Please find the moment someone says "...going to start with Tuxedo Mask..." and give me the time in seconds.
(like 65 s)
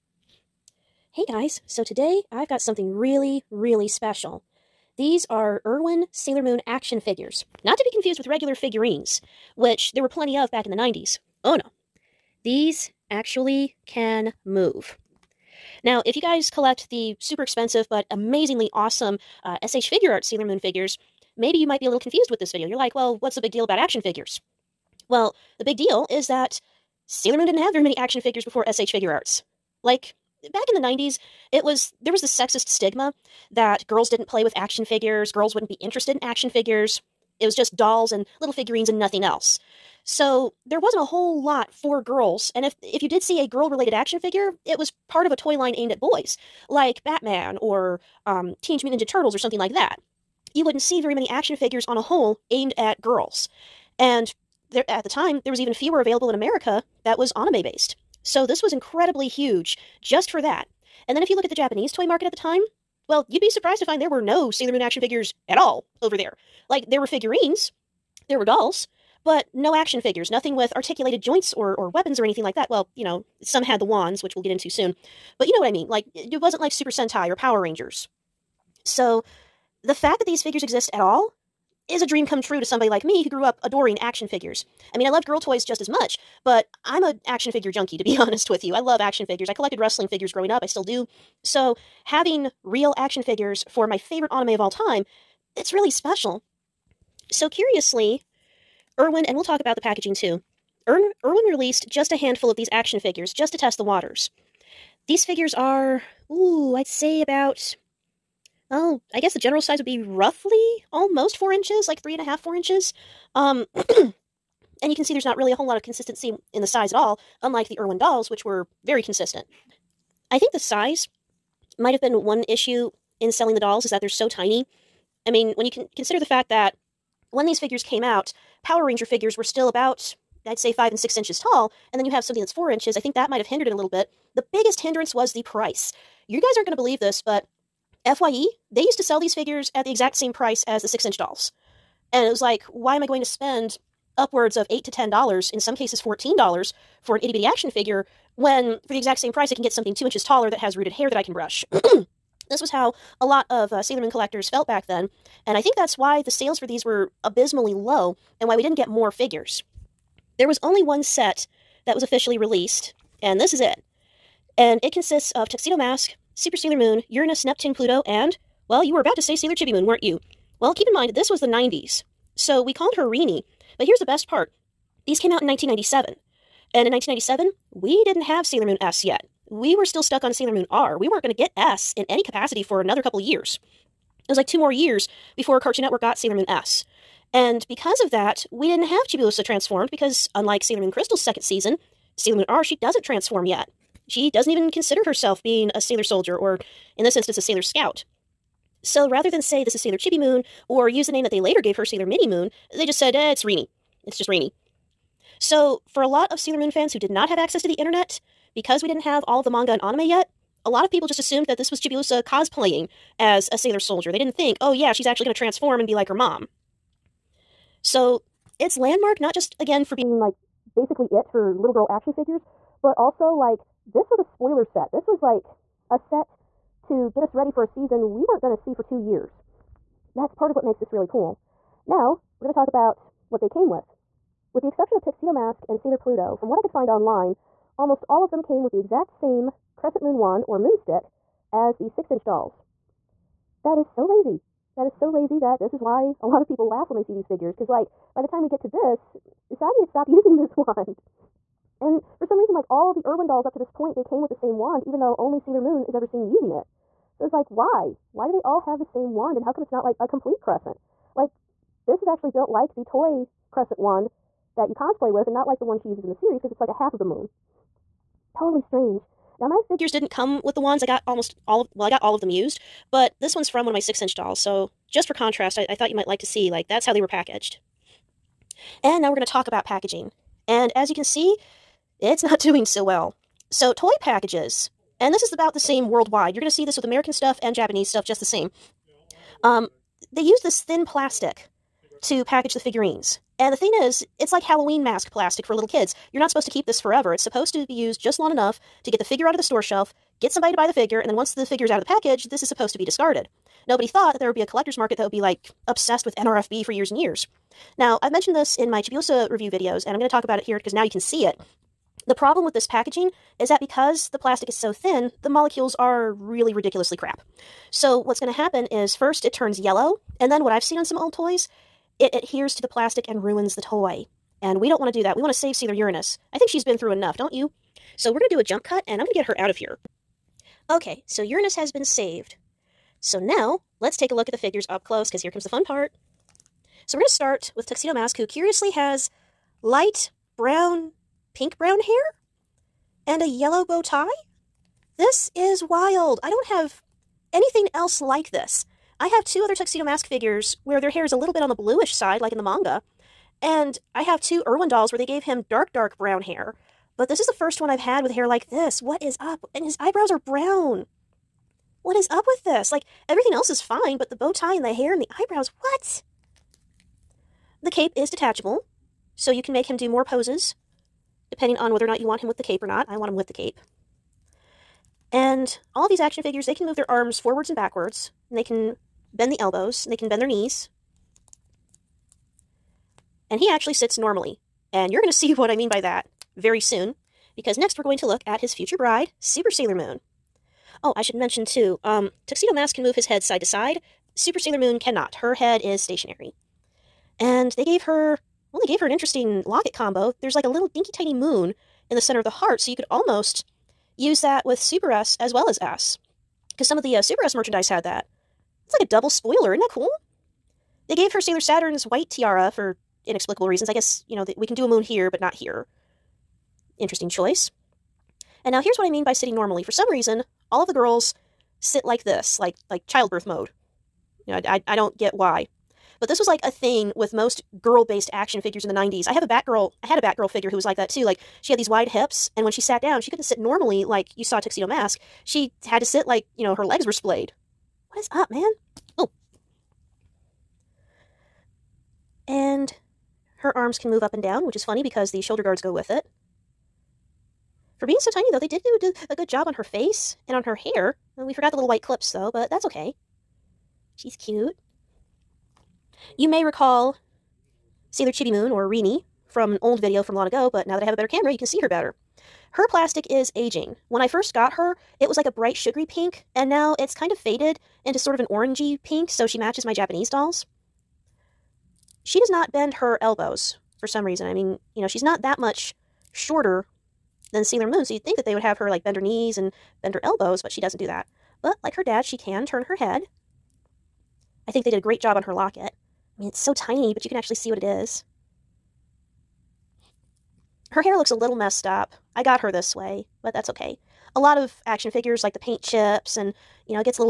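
336 s.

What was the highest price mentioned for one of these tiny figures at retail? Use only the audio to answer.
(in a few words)
$14.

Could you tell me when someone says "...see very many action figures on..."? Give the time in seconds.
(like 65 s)
50 s.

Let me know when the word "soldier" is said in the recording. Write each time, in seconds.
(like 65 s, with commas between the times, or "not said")
196 s, 213 s.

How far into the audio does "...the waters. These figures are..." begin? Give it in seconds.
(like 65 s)
103 s.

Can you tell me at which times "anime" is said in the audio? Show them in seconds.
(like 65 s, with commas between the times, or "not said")
57 s, 94 s, 209 s.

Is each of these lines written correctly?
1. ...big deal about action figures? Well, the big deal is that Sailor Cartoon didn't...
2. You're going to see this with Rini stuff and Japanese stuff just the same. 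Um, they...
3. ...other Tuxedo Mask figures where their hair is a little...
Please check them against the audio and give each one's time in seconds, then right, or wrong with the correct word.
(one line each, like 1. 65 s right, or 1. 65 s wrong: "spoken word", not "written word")
1. 23 s wrong: "Moon", not "Cartoon"
2. 286 s wrong: "American", not "Rini"
3. 349 s right.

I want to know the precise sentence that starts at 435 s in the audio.
She had to sit like, you know, her legs were splayed.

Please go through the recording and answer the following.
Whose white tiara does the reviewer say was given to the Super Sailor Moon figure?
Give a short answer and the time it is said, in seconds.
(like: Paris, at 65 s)
Sailor Saturn's, at 411 s.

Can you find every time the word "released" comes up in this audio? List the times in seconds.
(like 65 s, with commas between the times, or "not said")
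101 s, 162 s.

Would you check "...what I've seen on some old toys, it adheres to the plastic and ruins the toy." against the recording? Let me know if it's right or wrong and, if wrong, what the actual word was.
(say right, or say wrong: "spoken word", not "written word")
right.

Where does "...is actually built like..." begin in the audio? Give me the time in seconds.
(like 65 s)
262 s.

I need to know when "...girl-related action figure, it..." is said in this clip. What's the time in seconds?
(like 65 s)
43 s.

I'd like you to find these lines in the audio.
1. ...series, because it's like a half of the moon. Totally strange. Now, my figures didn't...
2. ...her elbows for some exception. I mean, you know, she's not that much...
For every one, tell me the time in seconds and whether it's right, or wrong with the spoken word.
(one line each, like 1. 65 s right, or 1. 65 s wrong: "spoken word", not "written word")
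1. 266 s right
2. 472 s wrong: "reason", not "exception".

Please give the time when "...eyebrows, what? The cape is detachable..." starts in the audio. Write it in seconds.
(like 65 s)
365 s.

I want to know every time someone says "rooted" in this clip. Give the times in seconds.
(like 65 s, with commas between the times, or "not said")
150 s.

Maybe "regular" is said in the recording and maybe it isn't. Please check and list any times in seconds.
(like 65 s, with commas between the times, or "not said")
8 s.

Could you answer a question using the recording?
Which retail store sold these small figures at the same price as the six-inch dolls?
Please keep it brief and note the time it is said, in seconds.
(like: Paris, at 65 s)
FYE, at 138 s.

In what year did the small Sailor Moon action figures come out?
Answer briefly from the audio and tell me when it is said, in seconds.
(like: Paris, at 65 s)
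1997, at 175 s.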